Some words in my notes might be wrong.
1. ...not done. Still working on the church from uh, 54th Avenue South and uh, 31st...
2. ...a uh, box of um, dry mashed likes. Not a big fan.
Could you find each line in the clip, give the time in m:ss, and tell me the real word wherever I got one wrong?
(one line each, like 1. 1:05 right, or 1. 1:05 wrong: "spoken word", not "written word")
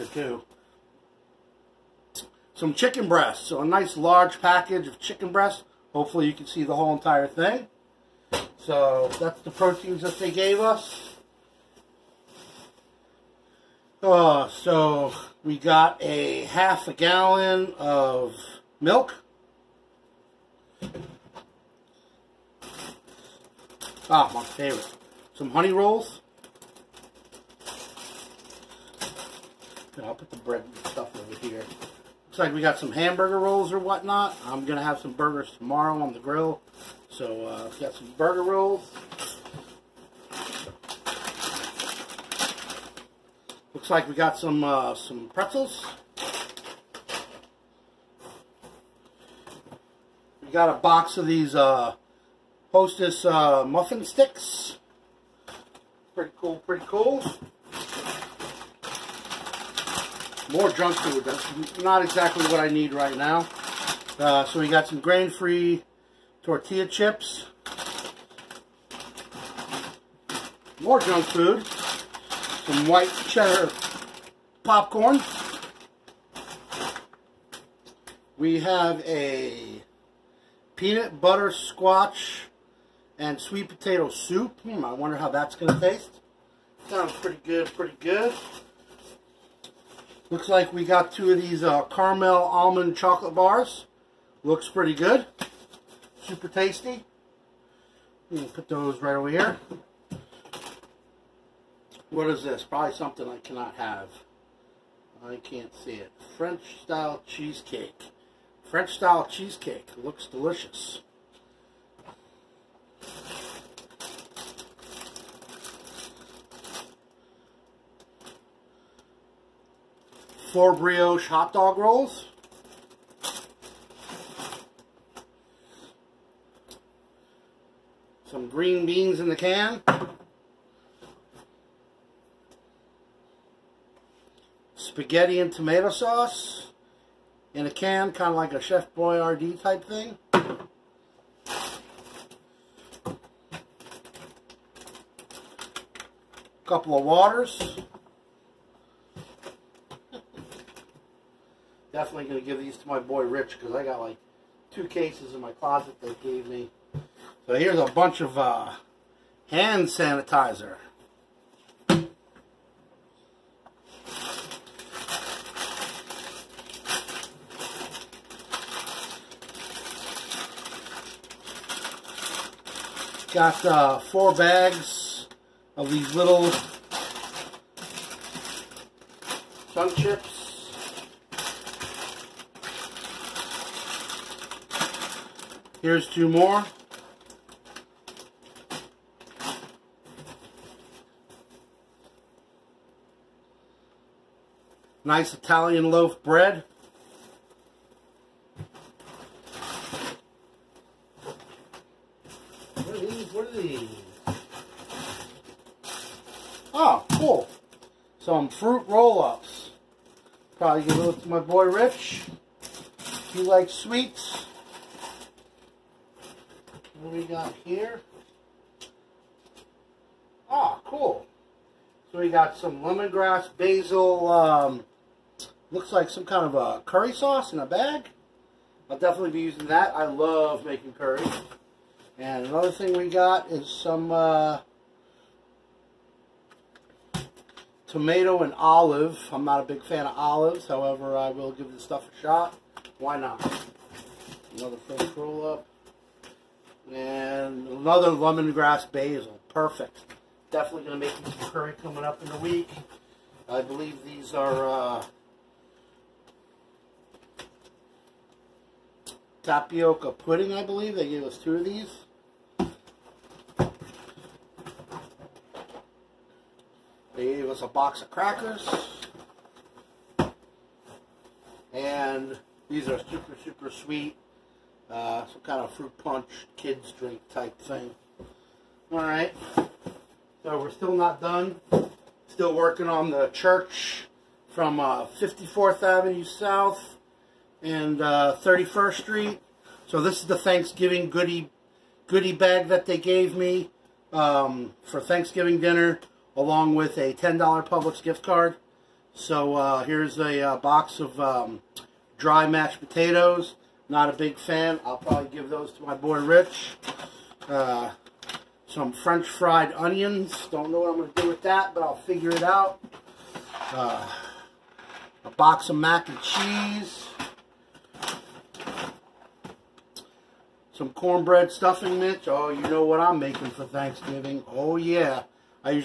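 1. 4:40 right
2. 5:00 wrong: "potatoes", not "likes".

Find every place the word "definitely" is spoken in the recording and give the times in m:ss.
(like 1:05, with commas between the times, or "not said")
2:32, 3:48, 4:10.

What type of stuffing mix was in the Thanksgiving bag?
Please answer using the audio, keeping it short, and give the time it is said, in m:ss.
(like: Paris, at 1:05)
Cornbread, at 5:20.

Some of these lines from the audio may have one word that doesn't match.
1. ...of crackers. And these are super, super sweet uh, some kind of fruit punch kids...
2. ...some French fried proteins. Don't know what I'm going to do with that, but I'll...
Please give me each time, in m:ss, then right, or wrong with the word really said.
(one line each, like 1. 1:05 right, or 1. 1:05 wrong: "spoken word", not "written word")
1. 4:28 right
2. 5:08 wrong: "onions", not "proteins".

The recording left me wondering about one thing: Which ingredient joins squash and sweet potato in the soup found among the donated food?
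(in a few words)
Peanut butter.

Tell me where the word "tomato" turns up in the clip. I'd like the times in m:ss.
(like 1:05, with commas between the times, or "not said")
2:15, 3:57.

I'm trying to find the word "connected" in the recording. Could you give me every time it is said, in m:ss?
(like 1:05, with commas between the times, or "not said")
not said.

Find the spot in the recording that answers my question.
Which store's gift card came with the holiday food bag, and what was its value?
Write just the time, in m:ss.
4:57.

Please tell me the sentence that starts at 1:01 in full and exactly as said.
That's not exactly what I need right now.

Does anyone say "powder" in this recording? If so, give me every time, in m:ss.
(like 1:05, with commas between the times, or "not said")
not said.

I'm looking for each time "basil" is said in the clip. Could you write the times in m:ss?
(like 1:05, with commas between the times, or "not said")
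3:43, 4:08.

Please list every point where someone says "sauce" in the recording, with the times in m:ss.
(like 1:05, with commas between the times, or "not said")
2:15, 3:47.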